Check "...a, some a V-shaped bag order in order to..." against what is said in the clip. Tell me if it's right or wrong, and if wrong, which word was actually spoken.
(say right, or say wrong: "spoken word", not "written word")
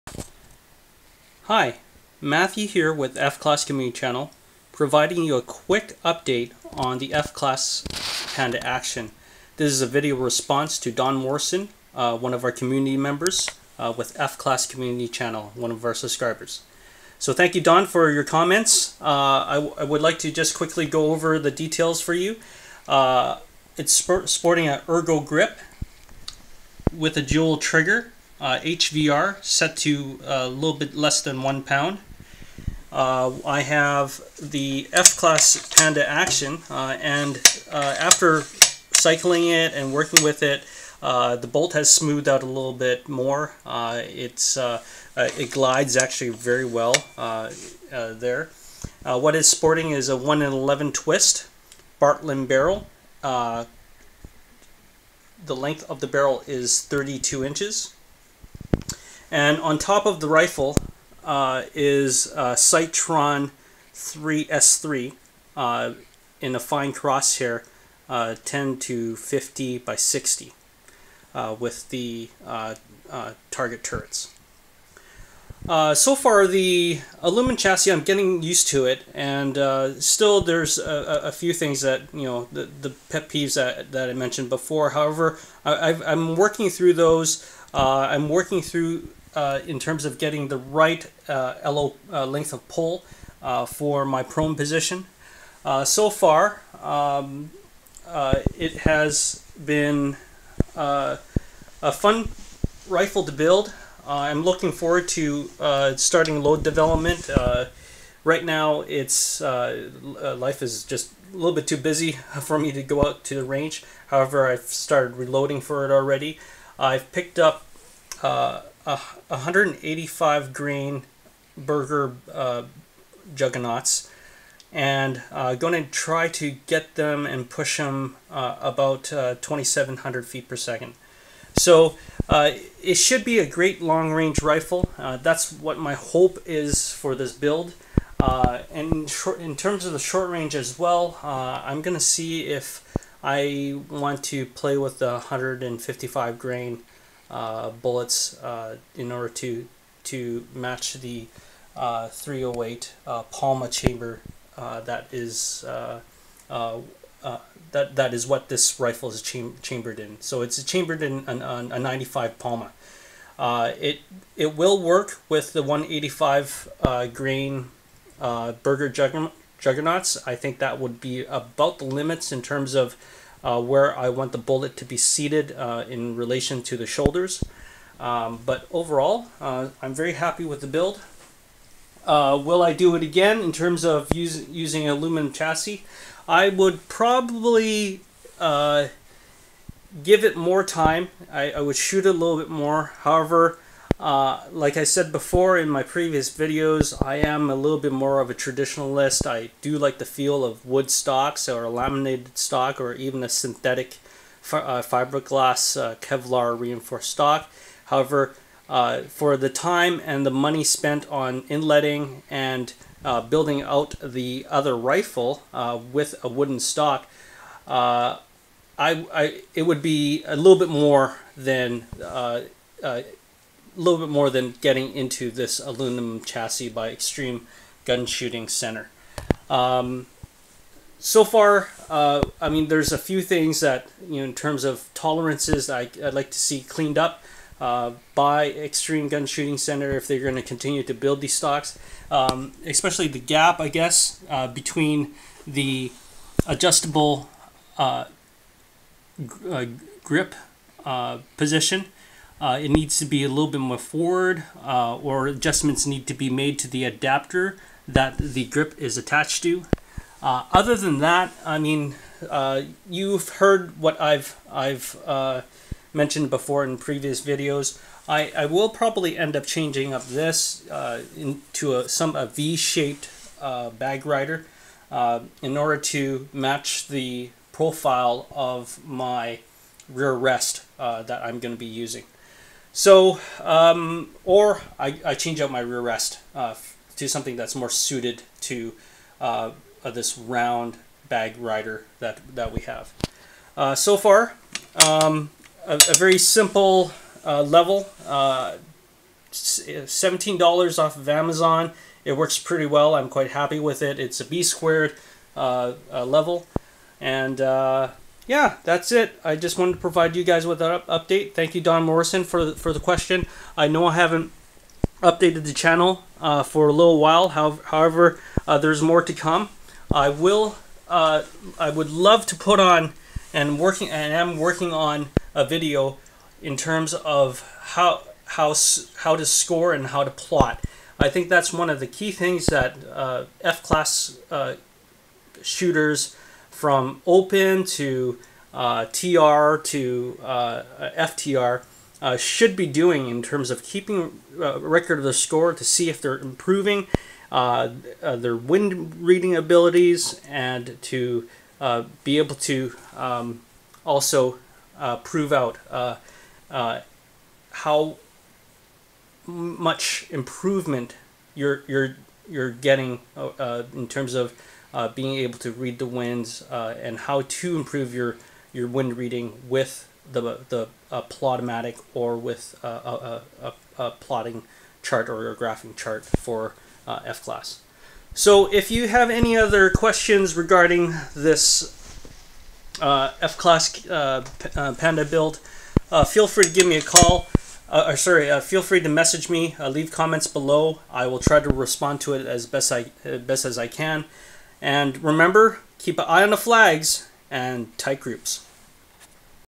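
wrong: "rider", not "order".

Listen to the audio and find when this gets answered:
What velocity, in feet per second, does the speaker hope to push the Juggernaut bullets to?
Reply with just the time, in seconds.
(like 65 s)
129 s.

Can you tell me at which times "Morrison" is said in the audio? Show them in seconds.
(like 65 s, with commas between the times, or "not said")
11 s, 311 s.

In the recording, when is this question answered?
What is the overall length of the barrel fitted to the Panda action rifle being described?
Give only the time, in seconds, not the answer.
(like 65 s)
56 s.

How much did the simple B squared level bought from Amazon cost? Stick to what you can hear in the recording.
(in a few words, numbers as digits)
$17.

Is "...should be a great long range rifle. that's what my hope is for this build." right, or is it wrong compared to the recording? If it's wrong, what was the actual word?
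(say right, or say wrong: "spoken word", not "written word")
right.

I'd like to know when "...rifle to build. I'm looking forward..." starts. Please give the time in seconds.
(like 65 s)
102 s.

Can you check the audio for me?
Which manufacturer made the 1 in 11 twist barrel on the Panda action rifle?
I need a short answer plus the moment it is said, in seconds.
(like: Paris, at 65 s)
Bartlein, at 52 s.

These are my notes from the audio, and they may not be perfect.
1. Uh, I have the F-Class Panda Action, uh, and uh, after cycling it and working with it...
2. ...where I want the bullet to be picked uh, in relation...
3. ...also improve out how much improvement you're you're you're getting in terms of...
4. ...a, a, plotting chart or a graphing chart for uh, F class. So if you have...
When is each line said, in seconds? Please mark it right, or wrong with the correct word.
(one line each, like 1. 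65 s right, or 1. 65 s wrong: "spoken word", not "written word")
1. 32 s right
2. 173 s wrong: "seated", not "picked"
3. 353 s wrong: "prove", not "improve"
4. 373 s right.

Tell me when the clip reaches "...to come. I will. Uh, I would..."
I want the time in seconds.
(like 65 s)
319 s.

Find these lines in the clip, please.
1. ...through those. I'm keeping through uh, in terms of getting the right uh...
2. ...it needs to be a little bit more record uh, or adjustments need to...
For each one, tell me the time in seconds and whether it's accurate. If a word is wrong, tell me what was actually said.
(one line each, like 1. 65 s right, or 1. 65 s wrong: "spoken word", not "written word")
1. 86 s wrong: "working", not "keeping"
2. 252 s wrong: "forward", not "record".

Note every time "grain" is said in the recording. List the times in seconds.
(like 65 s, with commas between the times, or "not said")
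120 s, 146 s, 167 s.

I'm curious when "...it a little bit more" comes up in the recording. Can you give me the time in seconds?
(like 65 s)
192 s.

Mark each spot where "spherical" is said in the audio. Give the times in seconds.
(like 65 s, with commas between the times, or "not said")
not said.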